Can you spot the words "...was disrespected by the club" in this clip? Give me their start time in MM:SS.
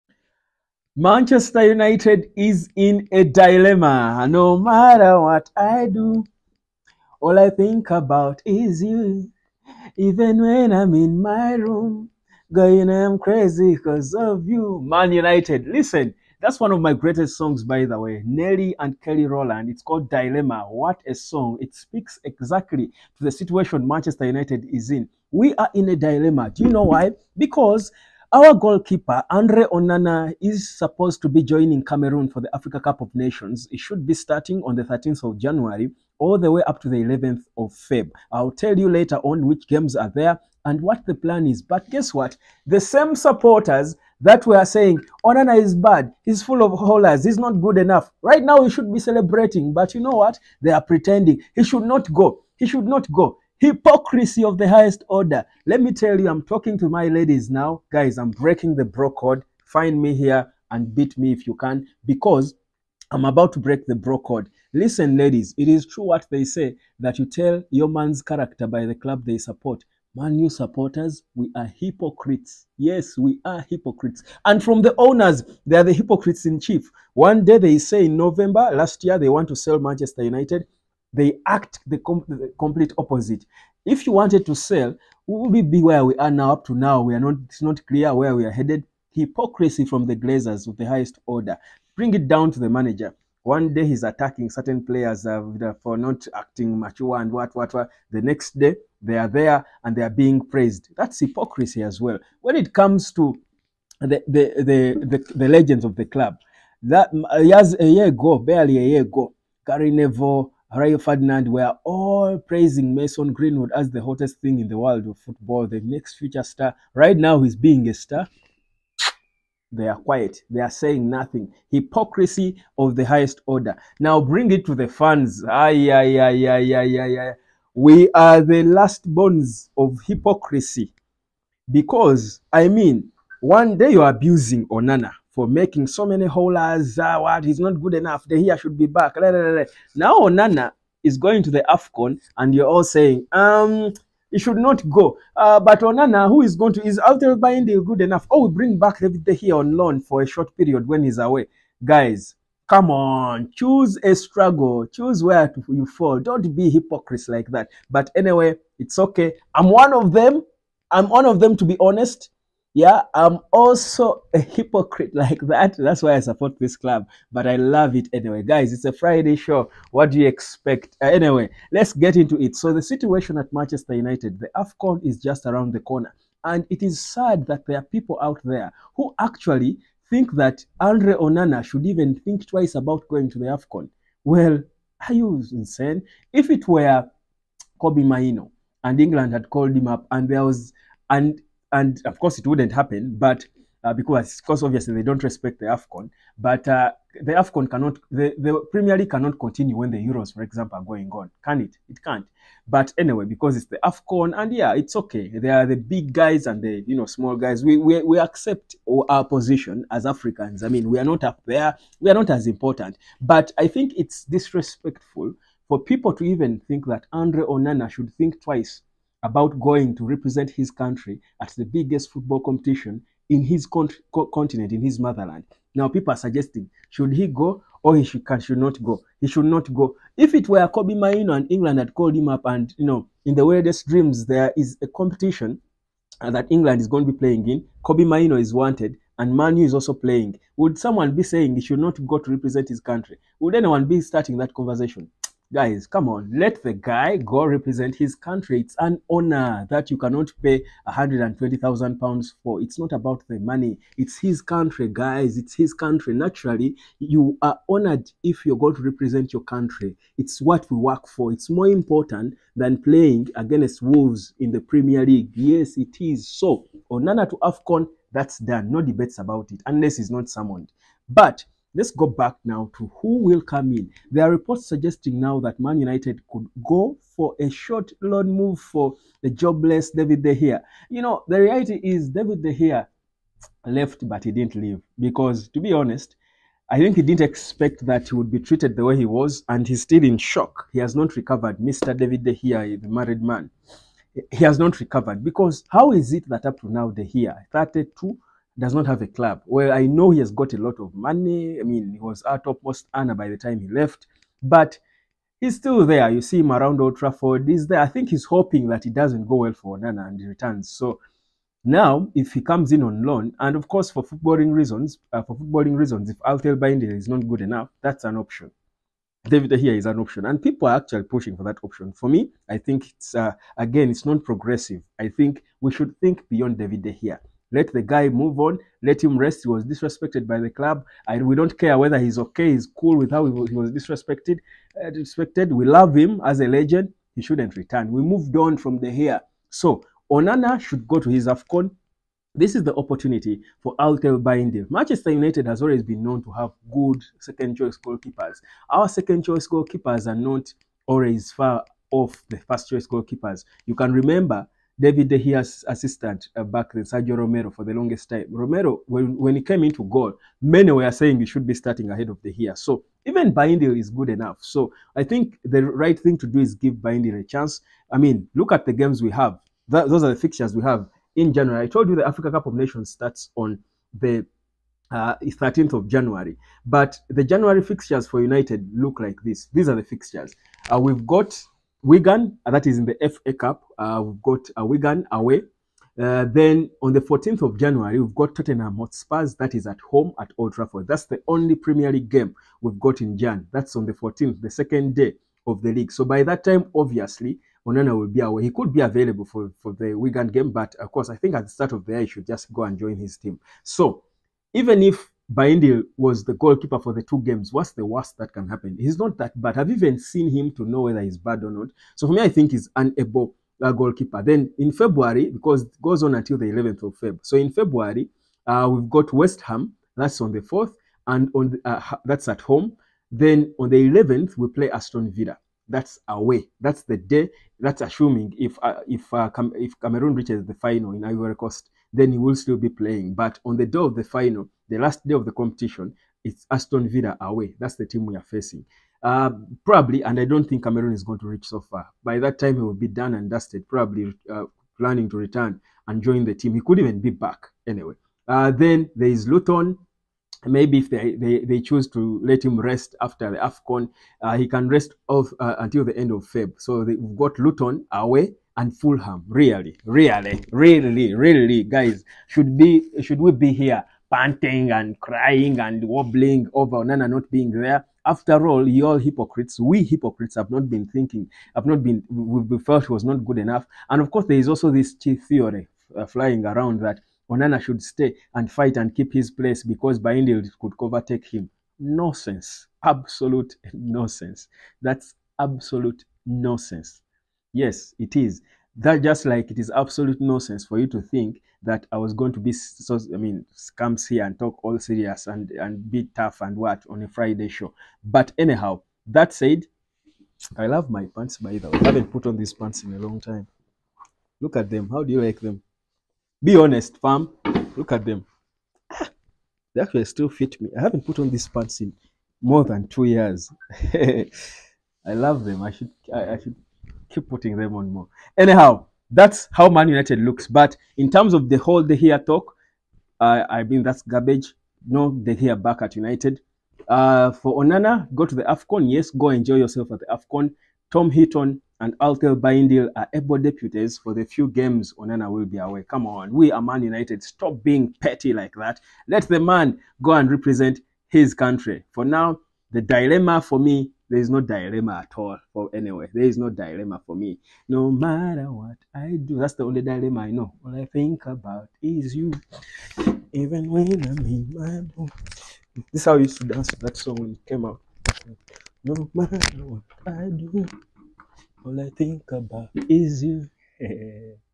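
05:29.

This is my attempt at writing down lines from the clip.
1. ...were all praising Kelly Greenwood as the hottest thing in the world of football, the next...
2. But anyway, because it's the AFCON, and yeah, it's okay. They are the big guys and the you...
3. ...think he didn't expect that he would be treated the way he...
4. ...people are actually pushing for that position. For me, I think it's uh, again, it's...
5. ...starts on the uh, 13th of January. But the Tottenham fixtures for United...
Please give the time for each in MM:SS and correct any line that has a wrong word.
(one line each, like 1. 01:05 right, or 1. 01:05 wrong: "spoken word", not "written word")
1. 01:51 wrong: "Mason", not "Kelly"
2. 03:22 right
3. 04:46 right
4. 05:20 wrong: "option", not "position"
5. 06:12 wrong: "January", not "Tottenham".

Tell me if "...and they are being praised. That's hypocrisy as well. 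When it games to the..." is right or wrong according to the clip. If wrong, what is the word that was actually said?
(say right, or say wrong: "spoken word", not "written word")
wrong: "comes", not "games".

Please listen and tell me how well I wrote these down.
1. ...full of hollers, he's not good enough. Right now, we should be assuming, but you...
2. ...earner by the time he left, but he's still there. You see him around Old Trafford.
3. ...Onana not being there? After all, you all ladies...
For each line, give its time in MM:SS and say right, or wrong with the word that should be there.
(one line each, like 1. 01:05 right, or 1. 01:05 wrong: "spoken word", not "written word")
1. 00:46 wrong: "celebrating", not "assuming"
2. 05:02 right
3. 07:46 wrong: "hypocrites", not "ladies".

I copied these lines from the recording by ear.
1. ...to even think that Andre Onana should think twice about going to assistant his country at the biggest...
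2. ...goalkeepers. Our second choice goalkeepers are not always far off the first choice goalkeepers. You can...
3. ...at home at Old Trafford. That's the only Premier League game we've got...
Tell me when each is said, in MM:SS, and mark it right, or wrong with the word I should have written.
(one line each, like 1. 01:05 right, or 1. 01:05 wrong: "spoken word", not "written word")
1. 03:36 wrong: "represent", not "assistant"
2. 05:47 right
3. 06:29 right.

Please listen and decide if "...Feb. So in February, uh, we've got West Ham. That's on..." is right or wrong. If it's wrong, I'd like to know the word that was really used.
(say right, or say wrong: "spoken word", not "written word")
right.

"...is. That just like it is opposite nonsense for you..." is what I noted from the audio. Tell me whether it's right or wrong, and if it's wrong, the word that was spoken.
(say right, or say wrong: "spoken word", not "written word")
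wrong: "absolute", not "opposite".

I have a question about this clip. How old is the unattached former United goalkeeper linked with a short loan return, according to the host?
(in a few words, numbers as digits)
32.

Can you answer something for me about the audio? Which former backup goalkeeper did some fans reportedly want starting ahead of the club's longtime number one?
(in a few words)
Sergio Romero.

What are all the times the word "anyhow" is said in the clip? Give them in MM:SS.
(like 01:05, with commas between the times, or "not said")
08:18, 08:38.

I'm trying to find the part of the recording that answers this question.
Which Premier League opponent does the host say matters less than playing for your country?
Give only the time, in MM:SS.
04:23.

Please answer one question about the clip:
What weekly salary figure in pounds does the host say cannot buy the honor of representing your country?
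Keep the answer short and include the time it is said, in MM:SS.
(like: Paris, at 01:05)
120000 pounds, at 04:10.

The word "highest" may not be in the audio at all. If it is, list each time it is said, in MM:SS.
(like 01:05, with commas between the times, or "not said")
00:54, 01:30, 02:03.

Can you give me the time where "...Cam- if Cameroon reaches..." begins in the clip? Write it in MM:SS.
07:09.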